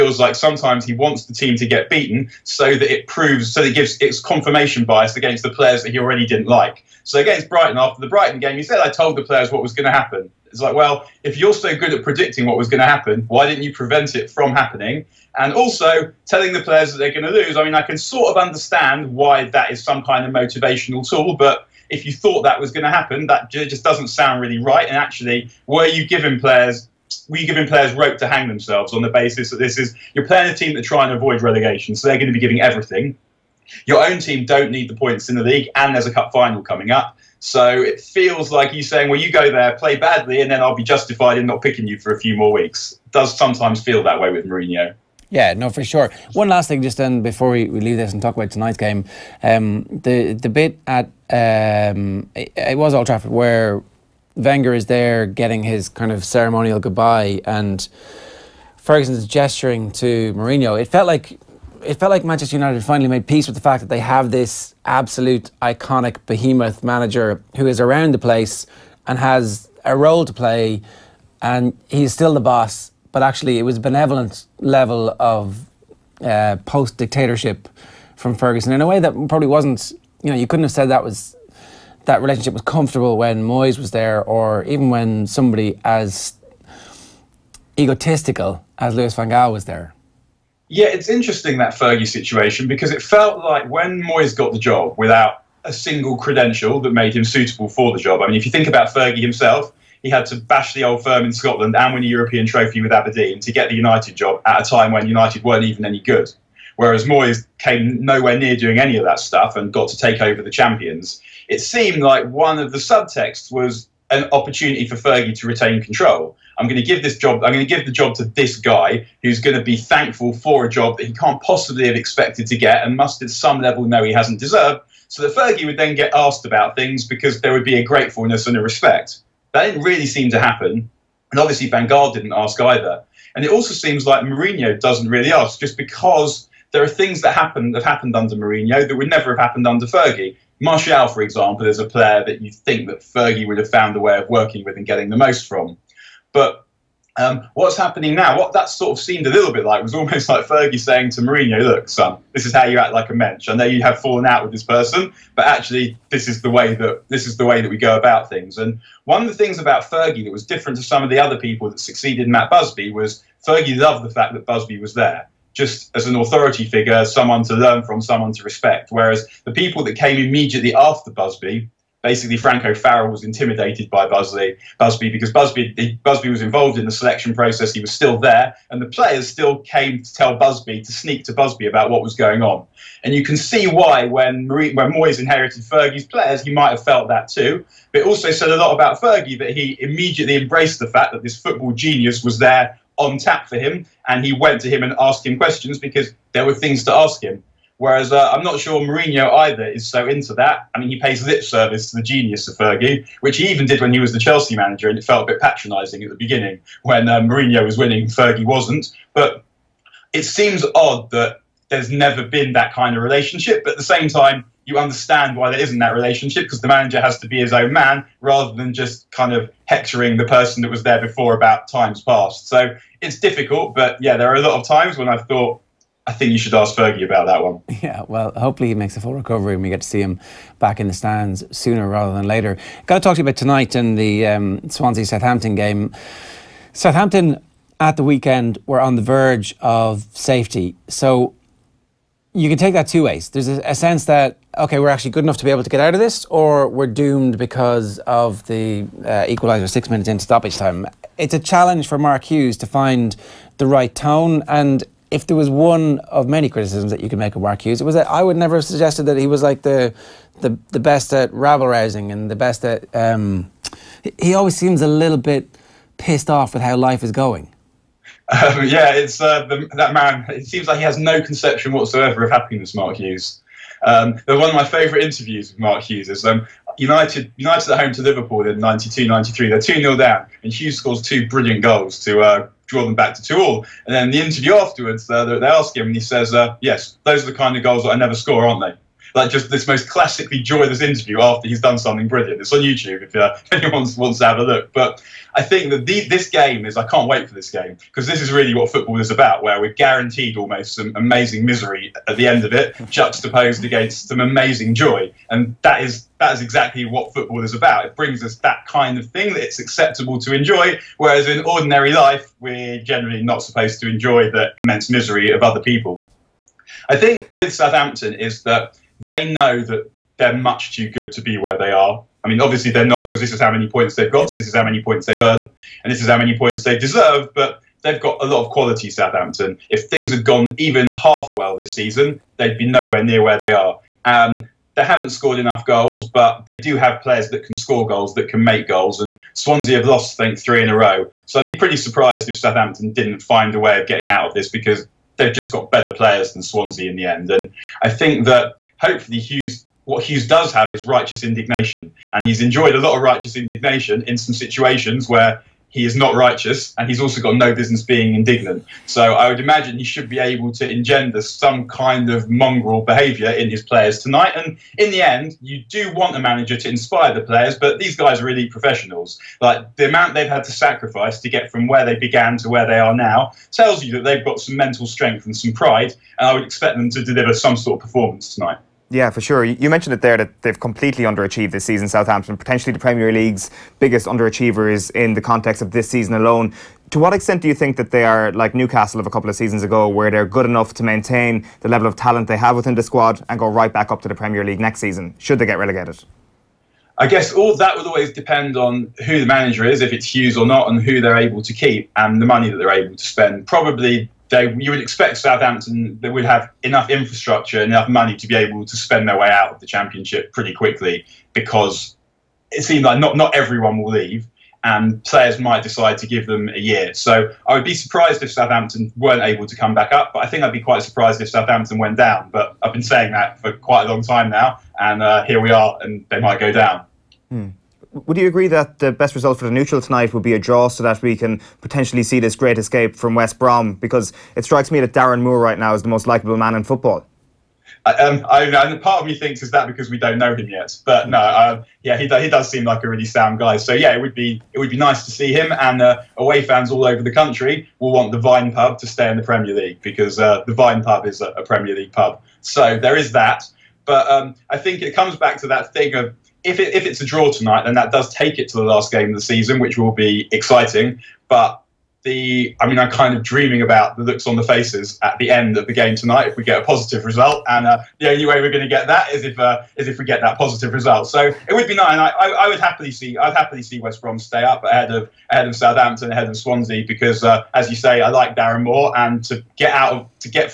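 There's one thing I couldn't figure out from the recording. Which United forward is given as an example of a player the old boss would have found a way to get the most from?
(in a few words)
Martial.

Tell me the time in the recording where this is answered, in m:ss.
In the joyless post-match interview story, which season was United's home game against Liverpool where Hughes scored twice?
4:38.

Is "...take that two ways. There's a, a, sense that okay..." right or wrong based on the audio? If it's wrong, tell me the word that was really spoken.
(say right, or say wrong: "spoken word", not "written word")
right.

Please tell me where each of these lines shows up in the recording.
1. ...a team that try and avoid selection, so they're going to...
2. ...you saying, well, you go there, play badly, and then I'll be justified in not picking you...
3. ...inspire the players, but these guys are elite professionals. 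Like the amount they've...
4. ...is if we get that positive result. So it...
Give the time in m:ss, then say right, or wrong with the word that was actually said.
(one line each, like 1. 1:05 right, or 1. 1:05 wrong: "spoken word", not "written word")
1. 0:30 wrong: "relegation", not "selection"
2. 0:38 right
3. 6:06 right
4. 7:49 right.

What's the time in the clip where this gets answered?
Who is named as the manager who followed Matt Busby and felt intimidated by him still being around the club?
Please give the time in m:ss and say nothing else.
2:52.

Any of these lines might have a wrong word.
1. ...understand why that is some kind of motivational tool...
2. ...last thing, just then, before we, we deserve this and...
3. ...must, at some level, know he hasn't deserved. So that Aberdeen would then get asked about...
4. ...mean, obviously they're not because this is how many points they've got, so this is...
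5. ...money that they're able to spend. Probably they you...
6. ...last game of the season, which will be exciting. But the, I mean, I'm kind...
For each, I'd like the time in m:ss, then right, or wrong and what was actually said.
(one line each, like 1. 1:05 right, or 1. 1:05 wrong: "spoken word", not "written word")
1. 0:18 right
2. 0:46 wrong: "leave", not "deserve"
3. 2:02 wrong: "Fergie", not "Aberdeen"
4. 5:22 right
5. 6:42 right
6. 7:38 right.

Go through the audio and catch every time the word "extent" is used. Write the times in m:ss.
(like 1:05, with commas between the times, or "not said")
6:27.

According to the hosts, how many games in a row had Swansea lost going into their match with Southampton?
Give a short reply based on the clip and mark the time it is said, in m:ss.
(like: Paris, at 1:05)
3, at 5:40.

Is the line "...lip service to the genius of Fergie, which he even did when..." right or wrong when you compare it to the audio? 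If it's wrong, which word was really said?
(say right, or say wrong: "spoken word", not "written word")
right.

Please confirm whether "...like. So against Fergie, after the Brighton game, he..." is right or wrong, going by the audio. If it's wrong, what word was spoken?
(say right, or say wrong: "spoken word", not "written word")
wrong: "Brighton", not "Fergie".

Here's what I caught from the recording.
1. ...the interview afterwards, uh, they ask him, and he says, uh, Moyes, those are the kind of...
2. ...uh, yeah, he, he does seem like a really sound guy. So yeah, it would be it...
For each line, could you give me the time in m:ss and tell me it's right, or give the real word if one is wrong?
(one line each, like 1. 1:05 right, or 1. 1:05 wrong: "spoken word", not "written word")
1. 4:44 wrong: "Yes", not "Moyes"
2. 7:21 right.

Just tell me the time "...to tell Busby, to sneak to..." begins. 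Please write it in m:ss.
3:00.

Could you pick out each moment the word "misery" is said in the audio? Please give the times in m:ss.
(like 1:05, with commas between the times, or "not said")
5:01, 5:14.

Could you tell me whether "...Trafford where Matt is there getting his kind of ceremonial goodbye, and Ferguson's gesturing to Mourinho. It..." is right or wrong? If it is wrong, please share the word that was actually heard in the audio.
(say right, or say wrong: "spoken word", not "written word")
wrong: "Wenger", not "Matt".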